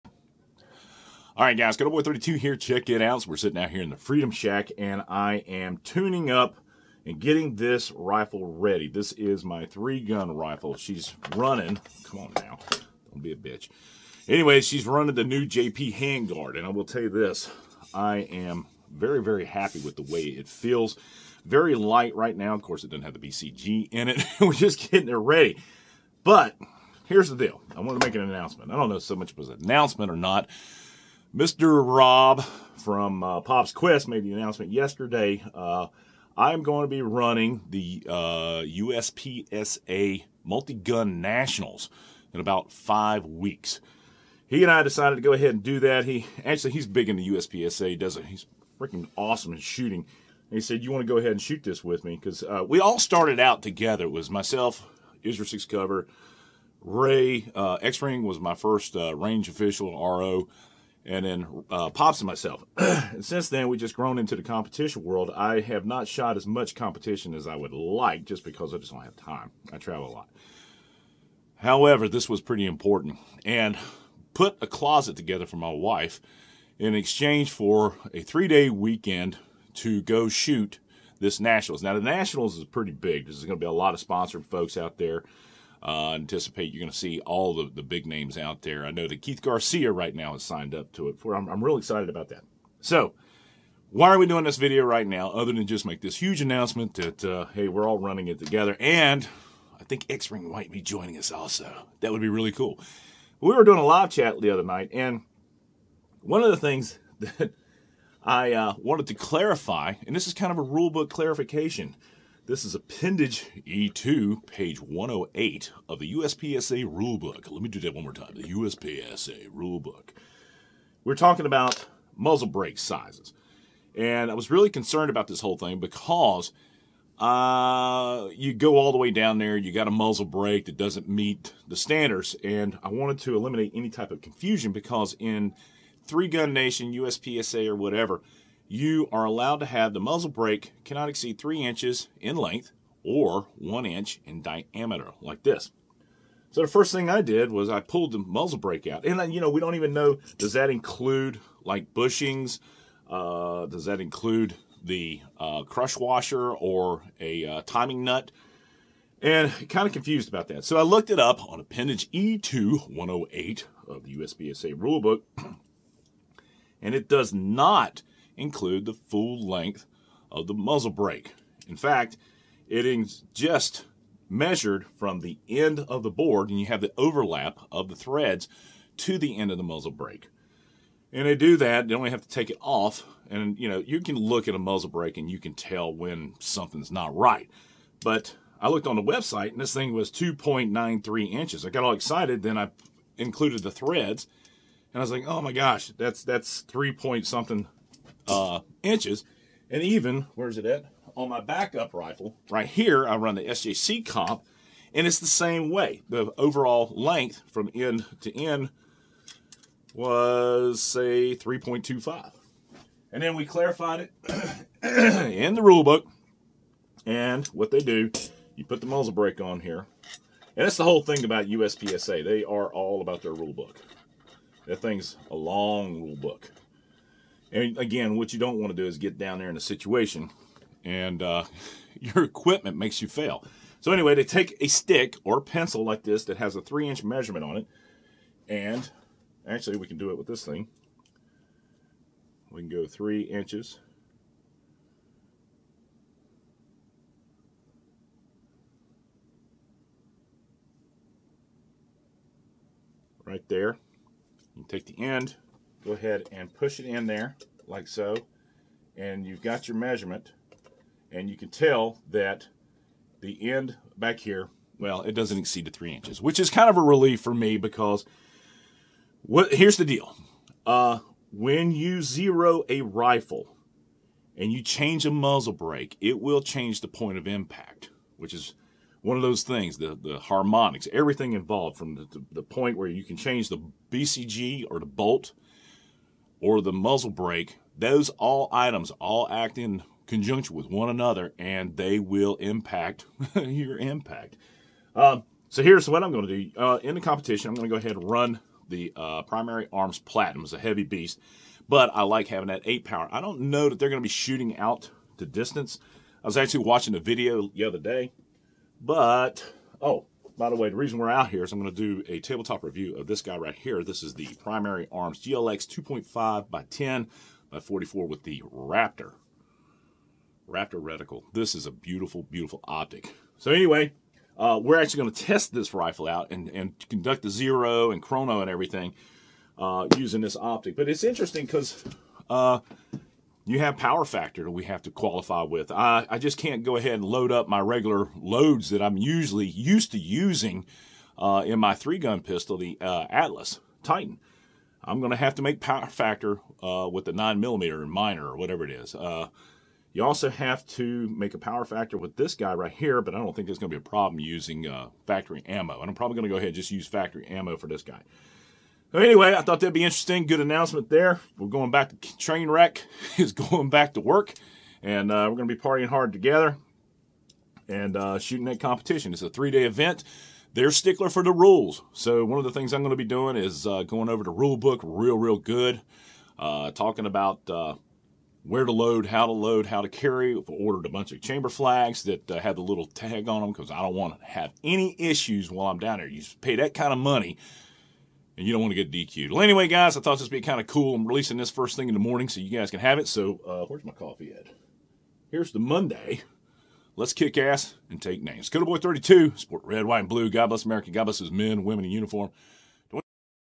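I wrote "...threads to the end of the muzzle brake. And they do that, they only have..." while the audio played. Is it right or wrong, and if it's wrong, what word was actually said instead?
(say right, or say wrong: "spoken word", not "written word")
right.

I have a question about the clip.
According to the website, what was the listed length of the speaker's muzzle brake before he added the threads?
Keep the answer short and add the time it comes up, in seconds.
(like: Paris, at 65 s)
2.93 inches, at 190 s.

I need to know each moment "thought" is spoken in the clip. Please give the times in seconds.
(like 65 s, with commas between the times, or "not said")
359 s, 390 s.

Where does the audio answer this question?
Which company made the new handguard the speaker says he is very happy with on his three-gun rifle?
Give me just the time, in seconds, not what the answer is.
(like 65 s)
15 s.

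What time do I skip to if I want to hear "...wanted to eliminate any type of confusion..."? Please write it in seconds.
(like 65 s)
132 s.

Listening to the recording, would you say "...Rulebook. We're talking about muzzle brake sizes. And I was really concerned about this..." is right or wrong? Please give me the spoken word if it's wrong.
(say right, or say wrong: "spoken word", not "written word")
right.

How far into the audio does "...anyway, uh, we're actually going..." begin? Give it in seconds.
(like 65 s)
323 s.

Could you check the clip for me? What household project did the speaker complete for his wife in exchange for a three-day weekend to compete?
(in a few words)
a closet.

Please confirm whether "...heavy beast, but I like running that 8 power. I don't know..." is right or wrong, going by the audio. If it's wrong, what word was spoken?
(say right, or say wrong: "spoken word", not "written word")
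wrong: "having", not "running".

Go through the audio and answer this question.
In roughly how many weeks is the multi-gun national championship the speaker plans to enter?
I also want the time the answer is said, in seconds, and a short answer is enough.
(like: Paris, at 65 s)
5, at 42 s.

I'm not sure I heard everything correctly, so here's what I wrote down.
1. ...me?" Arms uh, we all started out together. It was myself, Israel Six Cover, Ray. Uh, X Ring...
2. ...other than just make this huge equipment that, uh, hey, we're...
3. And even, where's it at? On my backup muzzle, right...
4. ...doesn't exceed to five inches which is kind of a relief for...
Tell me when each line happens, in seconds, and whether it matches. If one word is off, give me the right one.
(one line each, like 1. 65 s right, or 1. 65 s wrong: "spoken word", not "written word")
1. 52 s wrong: "Because", not "Arms"
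2. 95 s wrong: "announcement", not "equipment"
3. 199 s wrong: "rifle", not "muzzle"
4. 265 s wrong: "three", not "five".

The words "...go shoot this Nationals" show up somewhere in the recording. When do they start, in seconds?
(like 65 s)
80 s.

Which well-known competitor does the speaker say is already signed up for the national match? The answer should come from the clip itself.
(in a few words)
Keith Garcia.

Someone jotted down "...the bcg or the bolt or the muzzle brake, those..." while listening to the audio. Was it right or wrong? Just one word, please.
right.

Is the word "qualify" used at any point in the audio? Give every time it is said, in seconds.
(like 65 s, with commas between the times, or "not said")
334 s.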